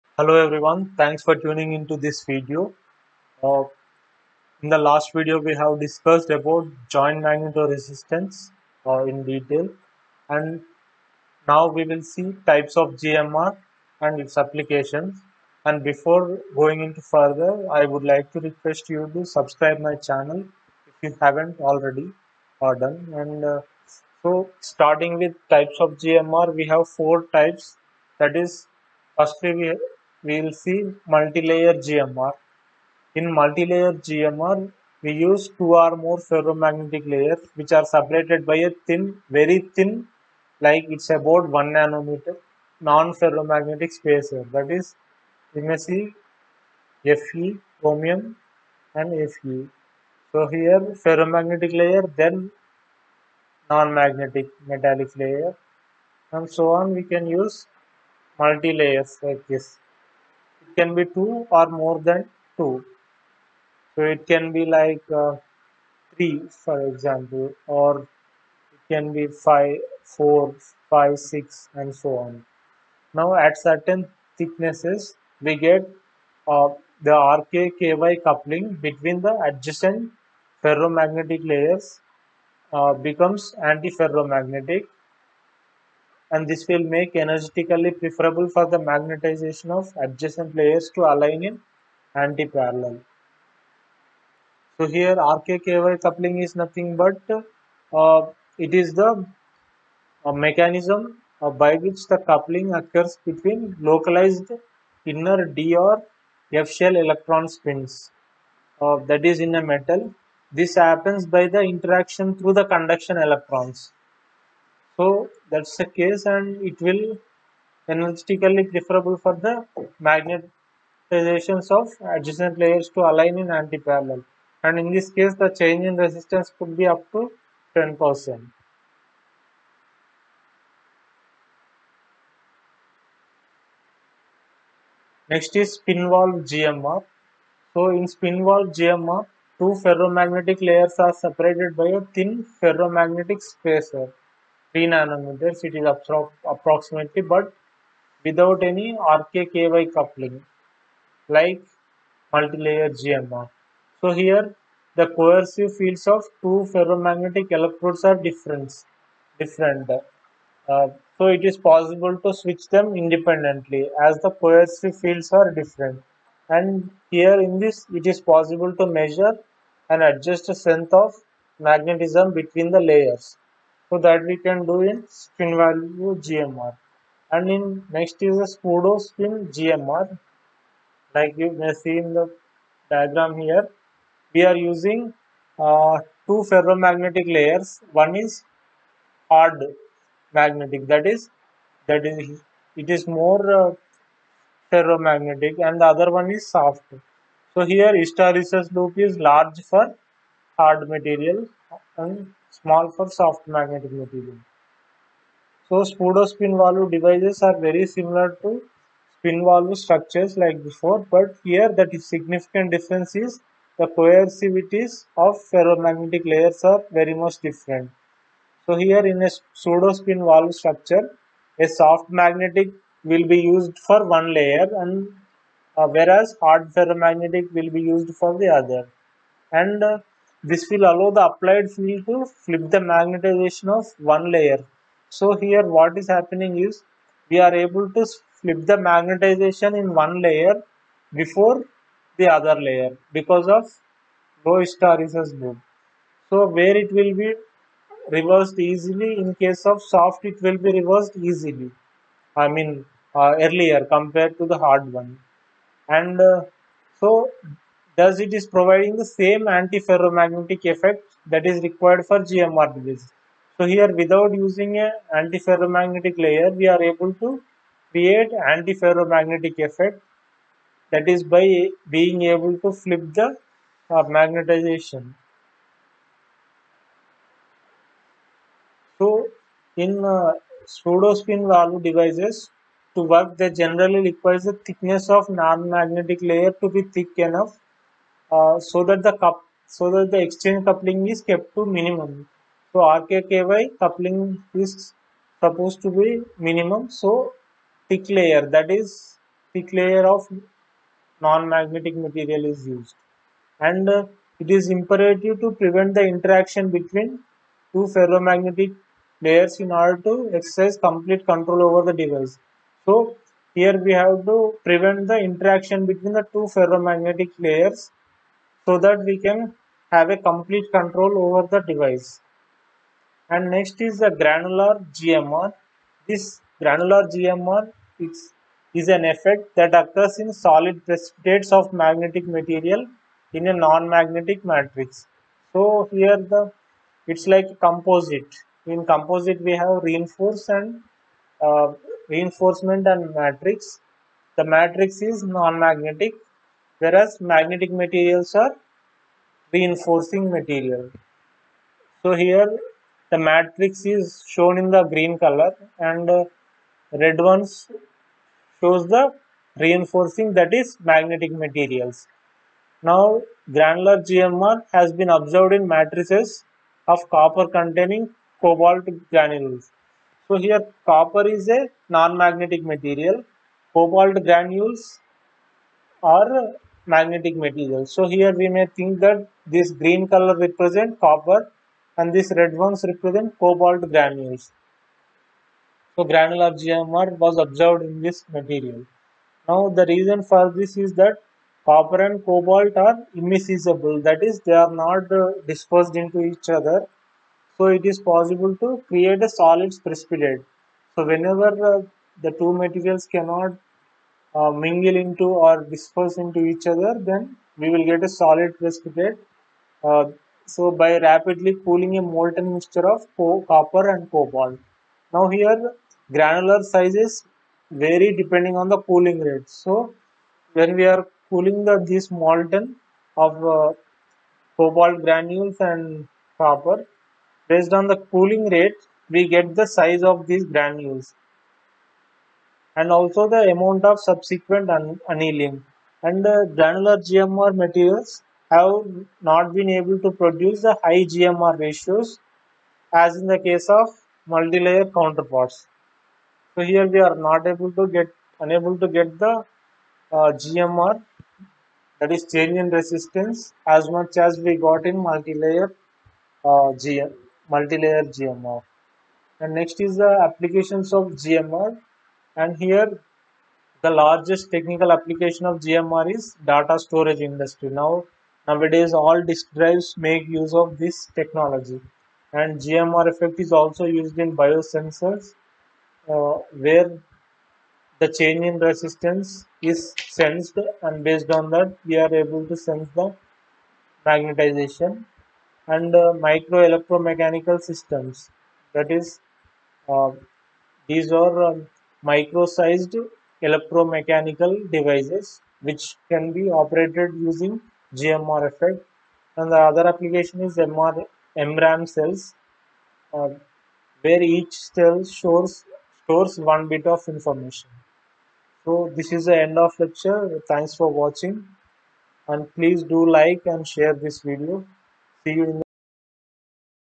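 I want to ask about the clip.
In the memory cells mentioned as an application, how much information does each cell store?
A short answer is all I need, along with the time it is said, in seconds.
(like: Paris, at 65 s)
1 bit, at 506 s.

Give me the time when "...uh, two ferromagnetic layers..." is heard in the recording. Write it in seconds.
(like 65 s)
185 s.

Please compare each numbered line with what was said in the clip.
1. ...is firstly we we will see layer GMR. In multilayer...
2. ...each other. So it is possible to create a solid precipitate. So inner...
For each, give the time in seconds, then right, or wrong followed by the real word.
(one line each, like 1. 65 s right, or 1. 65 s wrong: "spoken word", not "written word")
1. 28 s wrong: "multilayer", not "layer"
2. 396 s wrong: "whenever", not "inner".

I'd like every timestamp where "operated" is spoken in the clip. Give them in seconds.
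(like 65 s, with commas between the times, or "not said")
496 s.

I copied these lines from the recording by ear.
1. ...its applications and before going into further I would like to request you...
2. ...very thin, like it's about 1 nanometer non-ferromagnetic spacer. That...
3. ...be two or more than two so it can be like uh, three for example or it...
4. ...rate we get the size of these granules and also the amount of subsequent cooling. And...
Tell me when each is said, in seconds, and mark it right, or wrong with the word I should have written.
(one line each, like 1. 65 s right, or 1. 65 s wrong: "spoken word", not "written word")
1. 14 s right
2. 39 s right
3. 60 s right
4. 428 s wrong: "annealing", not "cooling".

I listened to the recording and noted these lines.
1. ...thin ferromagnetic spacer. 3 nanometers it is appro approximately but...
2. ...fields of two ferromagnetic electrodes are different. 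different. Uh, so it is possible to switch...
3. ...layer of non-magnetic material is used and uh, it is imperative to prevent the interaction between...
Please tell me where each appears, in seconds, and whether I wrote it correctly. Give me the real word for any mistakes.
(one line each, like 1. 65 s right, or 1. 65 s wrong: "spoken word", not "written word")
1. 142 s right
2. 155 s right
3. 299 s right.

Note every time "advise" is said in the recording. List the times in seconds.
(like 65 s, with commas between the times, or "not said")
not said.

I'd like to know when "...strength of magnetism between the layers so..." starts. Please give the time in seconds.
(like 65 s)
170 s.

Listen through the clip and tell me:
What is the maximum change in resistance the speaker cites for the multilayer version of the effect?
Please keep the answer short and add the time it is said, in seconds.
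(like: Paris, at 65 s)
10%, at 127 s.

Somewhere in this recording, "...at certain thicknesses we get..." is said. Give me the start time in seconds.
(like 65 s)
73 s.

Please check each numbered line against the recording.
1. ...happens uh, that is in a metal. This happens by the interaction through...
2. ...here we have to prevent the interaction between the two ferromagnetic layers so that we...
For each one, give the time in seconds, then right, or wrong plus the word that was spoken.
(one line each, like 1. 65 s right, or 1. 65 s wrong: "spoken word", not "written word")
1. 107 s wrong: "spins", not "happens"
2. 313 s right.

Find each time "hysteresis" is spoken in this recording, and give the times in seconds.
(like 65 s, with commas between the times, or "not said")
198 s, 244 s.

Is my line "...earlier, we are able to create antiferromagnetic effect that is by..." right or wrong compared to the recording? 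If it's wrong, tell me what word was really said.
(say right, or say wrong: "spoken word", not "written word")
wrong: "layer", not "earlier".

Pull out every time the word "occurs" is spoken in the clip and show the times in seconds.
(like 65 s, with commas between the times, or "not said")
102 s, 329 s.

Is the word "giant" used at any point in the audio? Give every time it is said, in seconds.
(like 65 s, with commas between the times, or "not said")
6 s.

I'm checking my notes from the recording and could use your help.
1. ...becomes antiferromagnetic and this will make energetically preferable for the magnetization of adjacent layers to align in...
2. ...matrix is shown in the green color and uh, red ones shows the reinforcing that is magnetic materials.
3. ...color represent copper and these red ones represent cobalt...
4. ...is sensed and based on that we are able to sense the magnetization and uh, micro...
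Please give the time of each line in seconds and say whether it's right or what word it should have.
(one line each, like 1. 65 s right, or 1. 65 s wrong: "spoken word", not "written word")
1. 82 s right
2. 353 s right
3. 380 s right
4. 479 s right.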